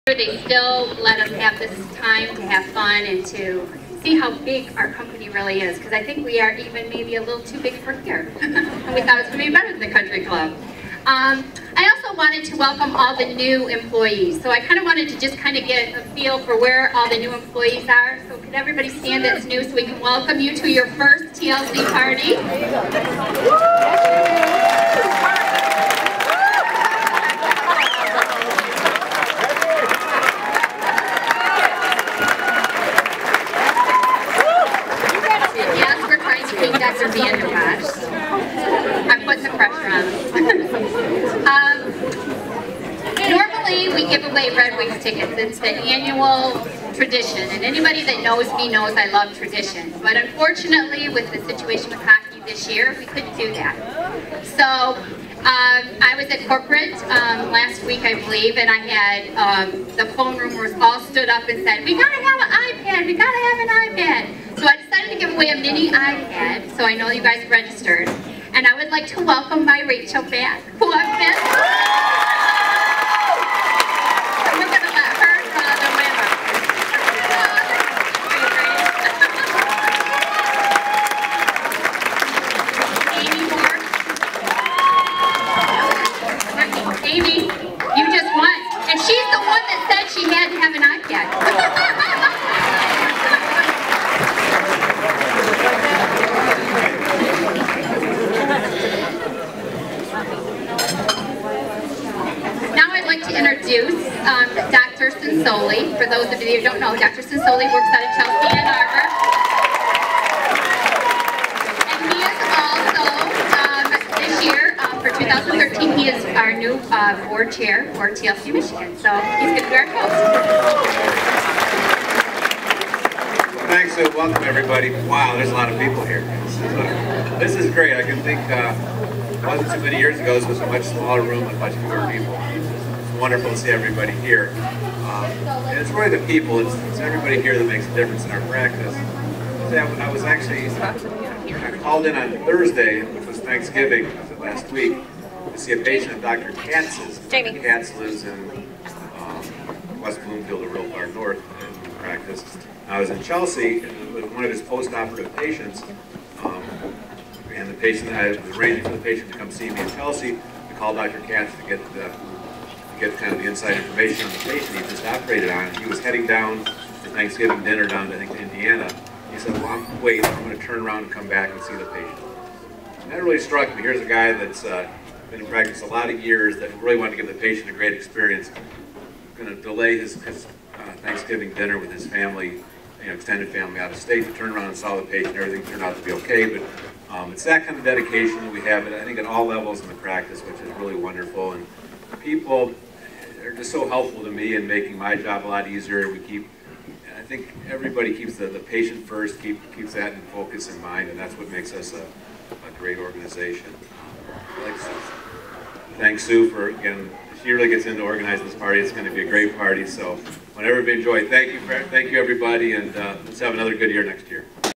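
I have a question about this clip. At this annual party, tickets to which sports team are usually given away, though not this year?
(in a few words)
Red Wings.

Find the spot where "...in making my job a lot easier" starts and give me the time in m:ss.
3:14.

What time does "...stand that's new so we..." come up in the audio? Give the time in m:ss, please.
0:18.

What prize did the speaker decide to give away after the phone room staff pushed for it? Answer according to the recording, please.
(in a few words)
mini iPad.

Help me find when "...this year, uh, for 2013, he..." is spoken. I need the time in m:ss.
1:54.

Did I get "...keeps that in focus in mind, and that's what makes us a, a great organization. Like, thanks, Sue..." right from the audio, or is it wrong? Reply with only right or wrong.
right.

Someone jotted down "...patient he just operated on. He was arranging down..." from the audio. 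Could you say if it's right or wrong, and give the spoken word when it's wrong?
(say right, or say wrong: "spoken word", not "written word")
wrong: "heading", not "arranging".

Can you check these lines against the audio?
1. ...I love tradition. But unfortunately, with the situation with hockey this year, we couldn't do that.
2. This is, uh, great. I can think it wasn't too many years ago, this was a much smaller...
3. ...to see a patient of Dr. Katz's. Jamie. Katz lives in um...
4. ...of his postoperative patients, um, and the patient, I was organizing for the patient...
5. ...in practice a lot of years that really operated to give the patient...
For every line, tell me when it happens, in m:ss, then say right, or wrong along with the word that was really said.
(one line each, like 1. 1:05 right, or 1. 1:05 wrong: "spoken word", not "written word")
1. 0:48 right
2. 2:07 right
3. 2:25 right
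4. 2:34 wrong: "arranging", not "organizing"
5. 2:55 wrong: "wanted", not "operated".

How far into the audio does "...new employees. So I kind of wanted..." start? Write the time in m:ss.
0:13.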